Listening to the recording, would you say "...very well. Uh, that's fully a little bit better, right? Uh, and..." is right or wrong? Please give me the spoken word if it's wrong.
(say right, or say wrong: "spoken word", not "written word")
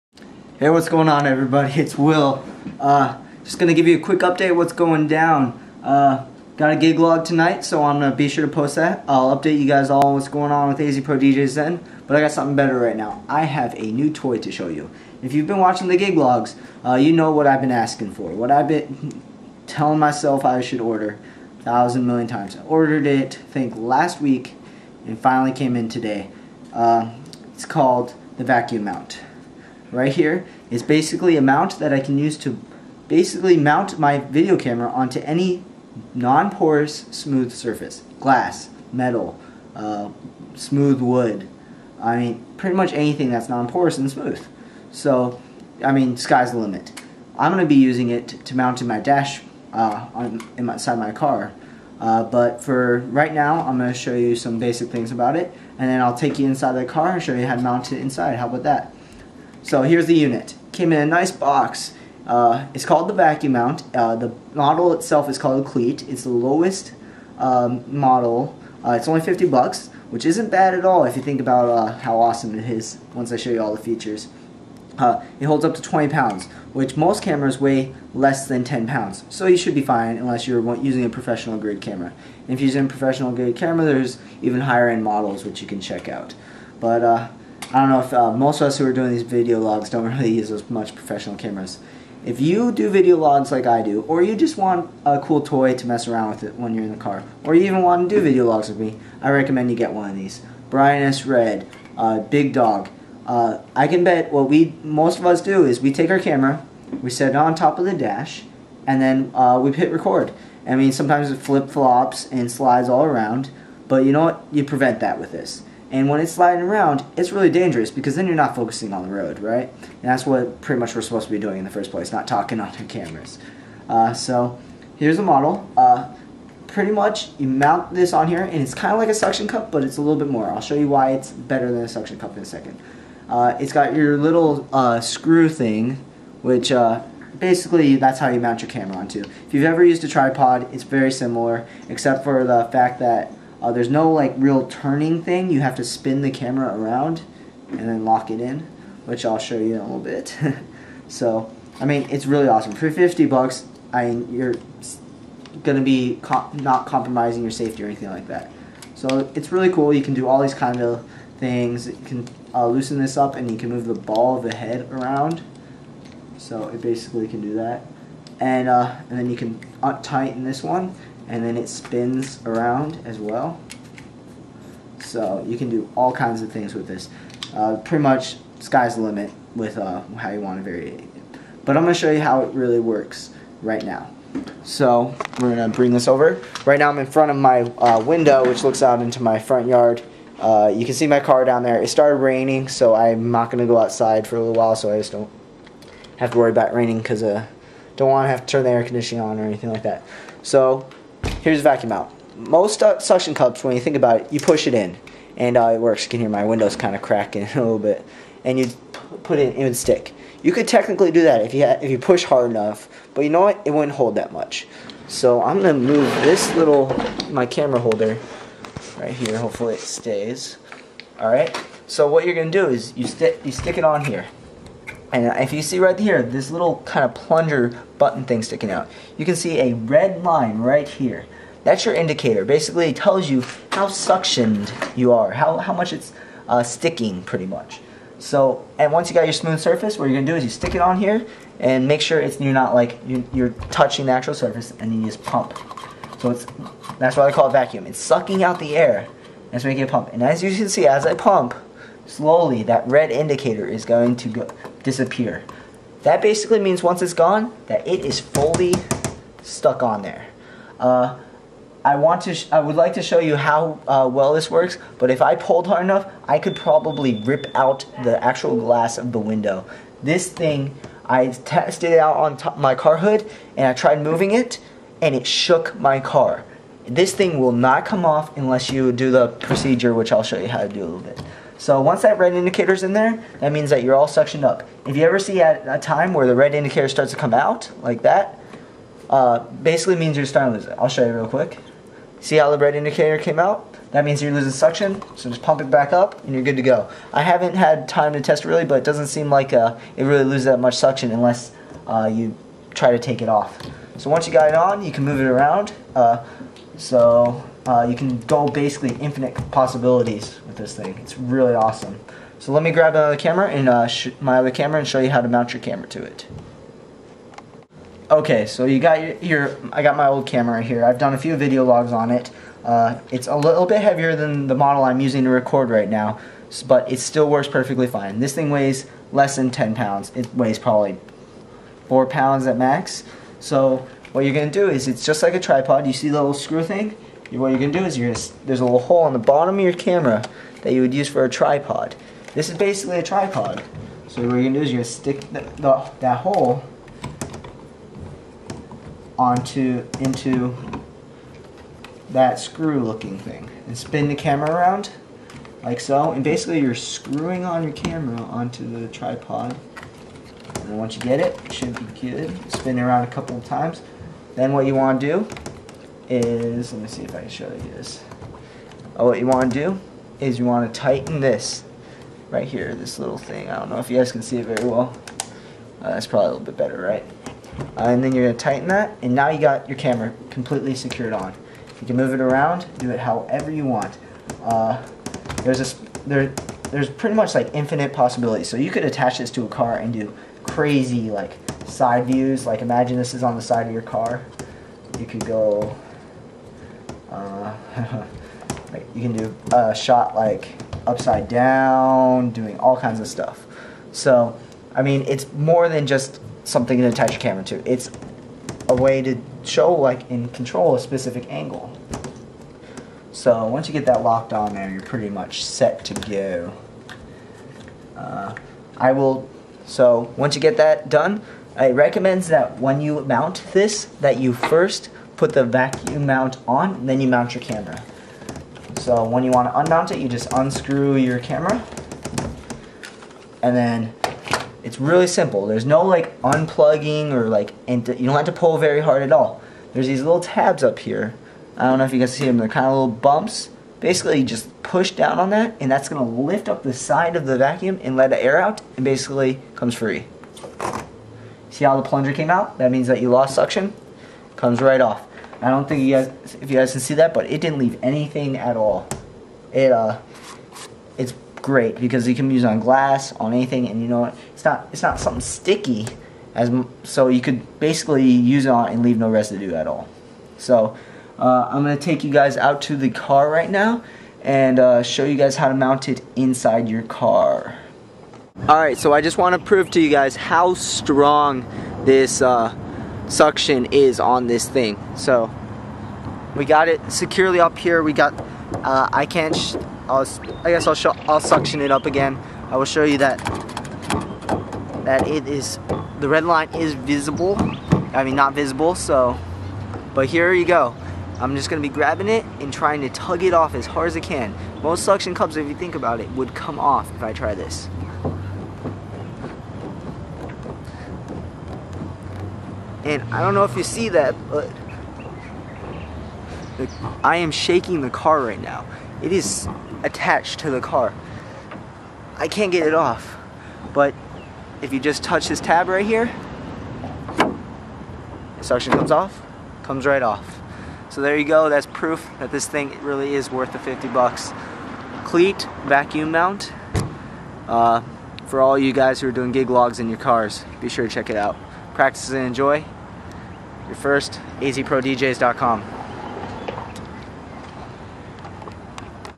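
wrong: "probably", not "fully".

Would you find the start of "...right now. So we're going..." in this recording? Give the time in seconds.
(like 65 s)
183 s.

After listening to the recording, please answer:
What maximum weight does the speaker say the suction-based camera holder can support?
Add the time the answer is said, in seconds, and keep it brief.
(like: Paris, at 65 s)
20 pounds, at 75 s.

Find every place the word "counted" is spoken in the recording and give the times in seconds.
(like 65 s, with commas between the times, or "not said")
not said.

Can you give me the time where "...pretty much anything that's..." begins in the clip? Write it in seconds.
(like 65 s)
42 s.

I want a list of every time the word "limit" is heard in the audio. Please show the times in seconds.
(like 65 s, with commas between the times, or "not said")
46 s, 179 s.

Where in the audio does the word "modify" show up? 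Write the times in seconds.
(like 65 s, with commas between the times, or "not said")
not said.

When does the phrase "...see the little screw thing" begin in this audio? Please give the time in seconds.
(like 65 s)
335 s.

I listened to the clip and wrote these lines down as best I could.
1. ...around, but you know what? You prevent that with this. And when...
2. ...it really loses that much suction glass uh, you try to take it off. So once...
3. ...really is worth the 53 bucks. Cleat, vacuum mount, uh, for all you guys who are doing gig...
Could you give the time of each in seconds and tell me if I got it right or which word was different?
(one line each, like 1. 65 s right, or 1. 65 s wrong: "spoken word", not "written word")
1. 113 s right
2. 299 s wrong: "unless", not "glass"
3. 532 s wrong: "50", not "53".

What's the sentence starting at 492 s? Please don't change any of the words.
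I will show you that, that it is, the red line is visible.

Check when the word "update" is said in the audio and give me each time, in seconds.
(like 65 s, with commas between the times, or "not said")
4 s, 9 s.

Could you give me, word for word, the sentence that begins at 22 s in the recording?
I ordered it, I think, last week, and finally came in today.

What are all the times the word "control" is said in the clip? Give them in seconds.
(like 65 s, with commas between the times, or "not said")
410 s.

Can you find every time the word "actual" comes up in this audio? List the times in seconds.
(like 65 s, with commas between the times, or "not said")
244 s, 268 s.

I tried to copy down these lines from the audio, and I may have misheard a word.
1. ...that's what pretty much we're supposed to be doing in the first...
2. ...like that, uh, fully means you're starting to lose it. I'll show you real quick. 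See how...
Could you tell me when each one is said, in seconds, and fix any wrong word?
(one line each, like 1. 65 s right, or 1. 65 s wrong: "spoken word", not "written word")
1. 120 s right
2. 287 s wrong: "basically", not "fully".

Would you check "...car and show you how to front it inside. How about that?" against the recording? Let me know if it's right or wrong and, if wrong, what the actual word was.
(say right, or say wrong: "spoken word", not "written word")
wrong: "mount", not "front".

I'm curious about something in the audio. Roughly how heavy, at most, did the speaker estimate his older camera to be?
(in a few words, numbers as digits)
4 pounds.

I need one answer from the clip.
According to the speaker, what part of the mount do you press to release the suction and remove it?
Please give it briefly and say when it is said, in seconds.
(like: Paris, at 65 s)
Tabs, at 440 s.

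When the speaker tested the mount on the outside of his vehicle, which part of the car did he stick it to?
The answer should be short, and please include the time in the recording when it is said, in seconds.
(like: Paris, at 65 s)
Car hood, at 272 s.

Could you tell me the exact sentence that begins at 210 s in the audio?
You could technically do that if you if you push hard enough, but you know what?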